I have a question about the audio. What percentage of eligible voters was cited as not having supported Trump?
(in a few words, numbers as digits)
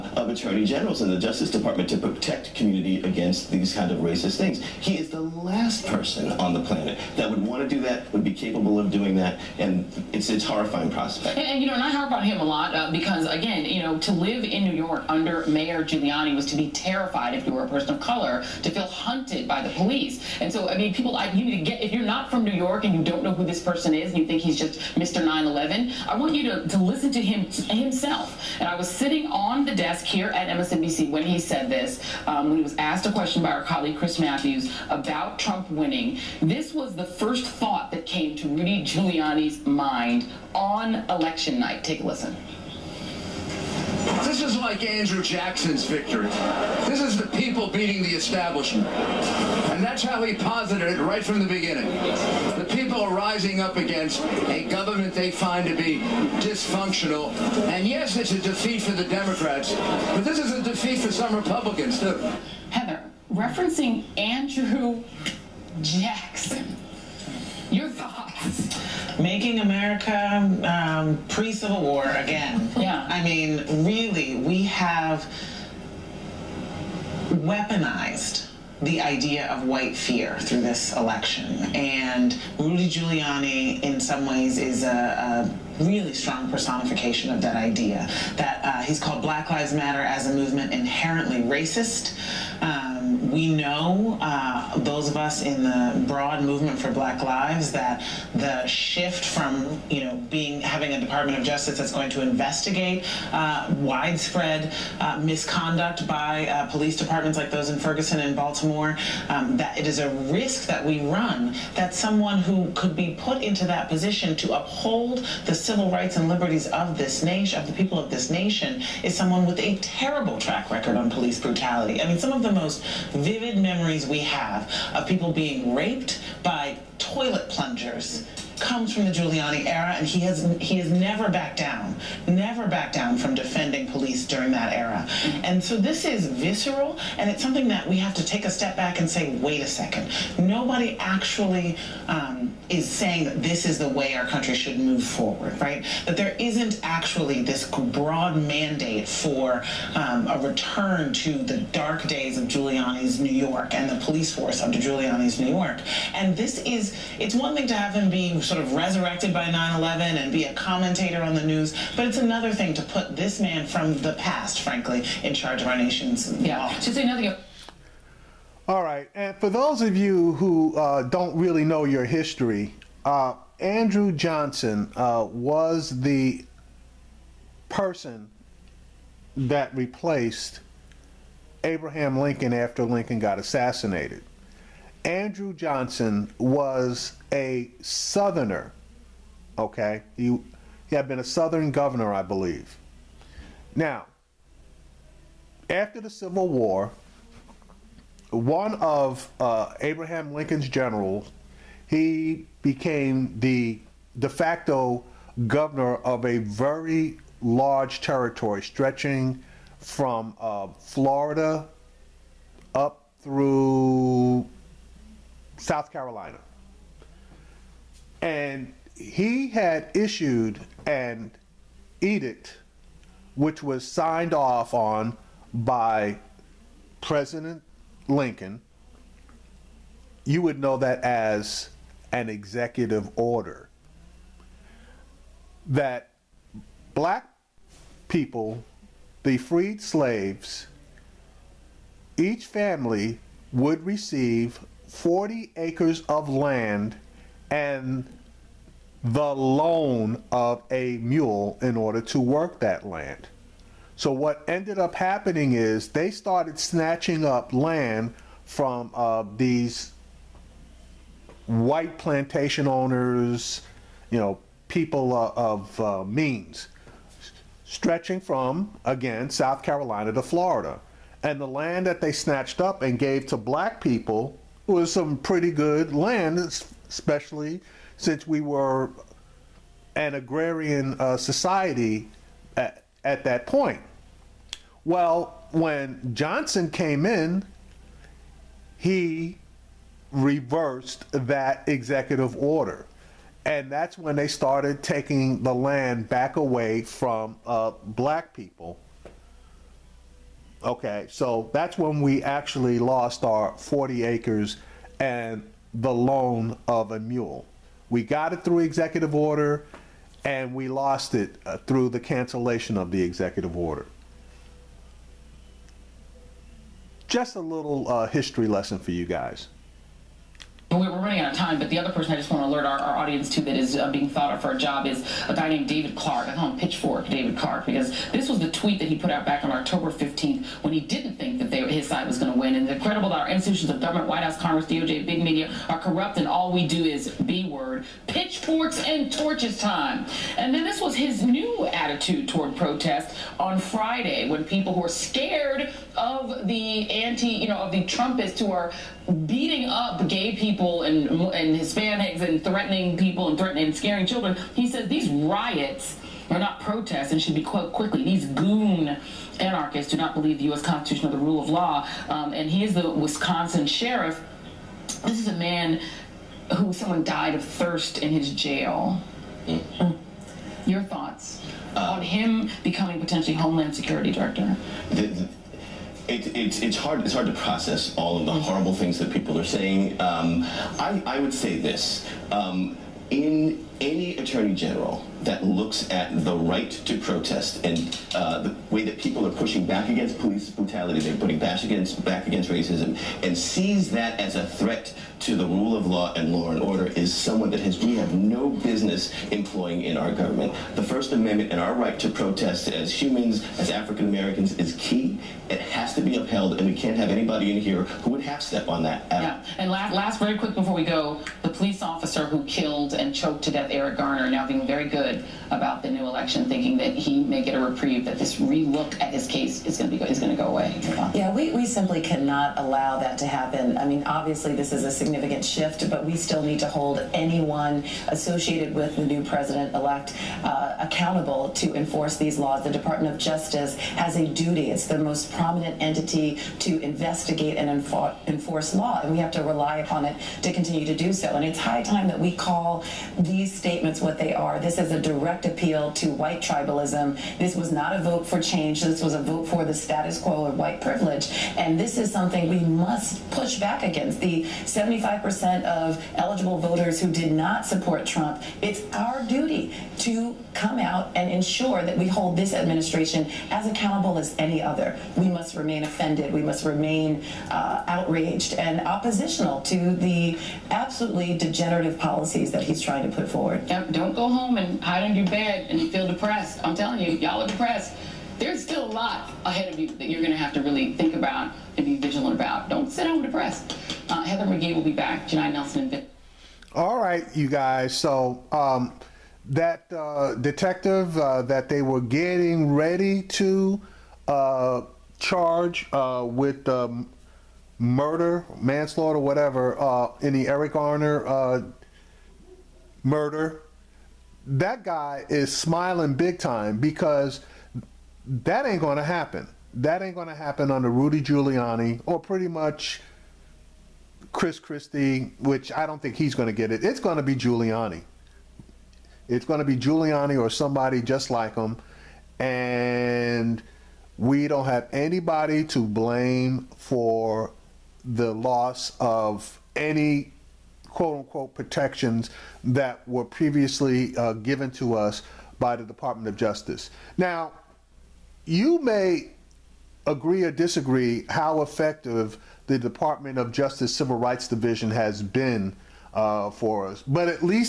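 75%.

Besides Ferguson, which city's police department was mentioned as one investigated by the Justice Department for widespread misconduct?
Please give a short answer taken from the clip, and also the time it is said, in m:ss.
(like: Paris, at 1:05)
Baltimore, at 1:48.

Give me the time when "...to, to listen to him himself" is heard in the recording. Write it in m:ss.
0:26.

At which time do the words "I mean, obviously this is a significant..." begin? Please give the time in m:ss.
7:03.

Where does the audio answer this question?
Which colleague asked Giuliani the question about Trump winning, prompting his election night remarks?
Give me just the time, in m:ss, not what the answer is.
0:33.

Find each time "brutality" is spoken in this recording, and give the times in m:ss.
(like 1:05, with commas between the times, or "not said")
2:01, 6:30.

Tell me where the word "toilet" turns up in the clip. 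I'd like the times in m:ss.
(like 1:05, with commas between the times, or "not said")
2:06.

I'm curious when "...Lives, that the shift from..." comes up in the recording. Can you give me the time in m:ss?
1:37.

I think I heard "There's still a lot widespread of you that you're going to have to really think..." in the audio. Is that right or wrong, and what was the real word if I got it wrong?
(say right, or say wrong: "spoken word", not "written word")
wrong: "ahead", not "widespread".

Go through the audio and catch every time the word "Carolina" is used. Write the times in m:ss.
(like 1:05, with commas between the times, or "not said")
3:35, 4:29.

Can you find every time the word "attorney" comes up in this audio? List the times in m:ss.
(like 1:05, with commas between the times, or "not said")
0:00, 6:24.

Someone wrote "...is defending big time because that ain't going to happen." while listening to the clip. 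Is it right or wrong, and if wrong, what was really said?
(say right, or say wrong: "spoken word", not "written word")
wrong: "smiling", not "defending".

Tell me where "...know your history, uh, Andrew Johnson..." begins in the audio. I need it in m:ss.
2:51.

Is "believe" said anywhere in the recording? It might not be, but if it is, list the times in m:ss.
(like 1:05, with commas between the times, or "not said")
3:12, 6:00.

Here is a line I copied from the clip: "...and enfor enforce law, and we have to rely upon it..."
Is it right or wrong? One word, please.
right.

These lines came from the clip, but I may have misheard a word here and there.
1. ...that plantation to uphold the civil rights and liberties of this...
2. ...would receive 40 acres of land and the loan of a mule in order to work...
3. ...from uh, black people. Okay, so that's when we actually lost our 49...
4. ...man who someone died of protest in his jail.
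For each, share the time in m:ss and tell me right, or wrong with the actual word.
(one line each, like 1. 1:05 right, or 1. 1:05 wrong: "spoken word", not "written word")
1. 1:53 wrong: "position", not "plantation"
2. 4:03 right
3. 4:56 wrong: "40", not "49"
4. 6:05 wrong: "thirst", not "protest".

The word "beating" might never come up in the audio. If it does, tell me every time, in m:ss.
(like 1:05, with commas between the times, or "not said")
0:47, 5:49.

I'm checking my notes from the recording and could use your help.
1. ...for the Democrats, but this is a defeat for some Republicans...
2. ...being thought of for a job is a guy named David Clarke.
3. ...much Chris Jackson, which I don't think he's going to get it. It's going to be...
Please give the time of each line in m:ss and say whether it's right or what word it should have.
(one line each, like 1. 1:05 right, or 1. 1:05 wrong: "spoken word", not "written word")
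1. 0:58 right
2. 5:23 right
3. 8:32 wrong: "Christie", not "Jackson".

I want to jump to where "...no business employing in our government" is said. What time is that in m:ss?
6:38.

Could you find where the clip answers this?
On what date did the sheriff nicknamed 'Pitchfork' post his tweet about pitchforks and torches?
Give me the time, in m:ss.
5:29.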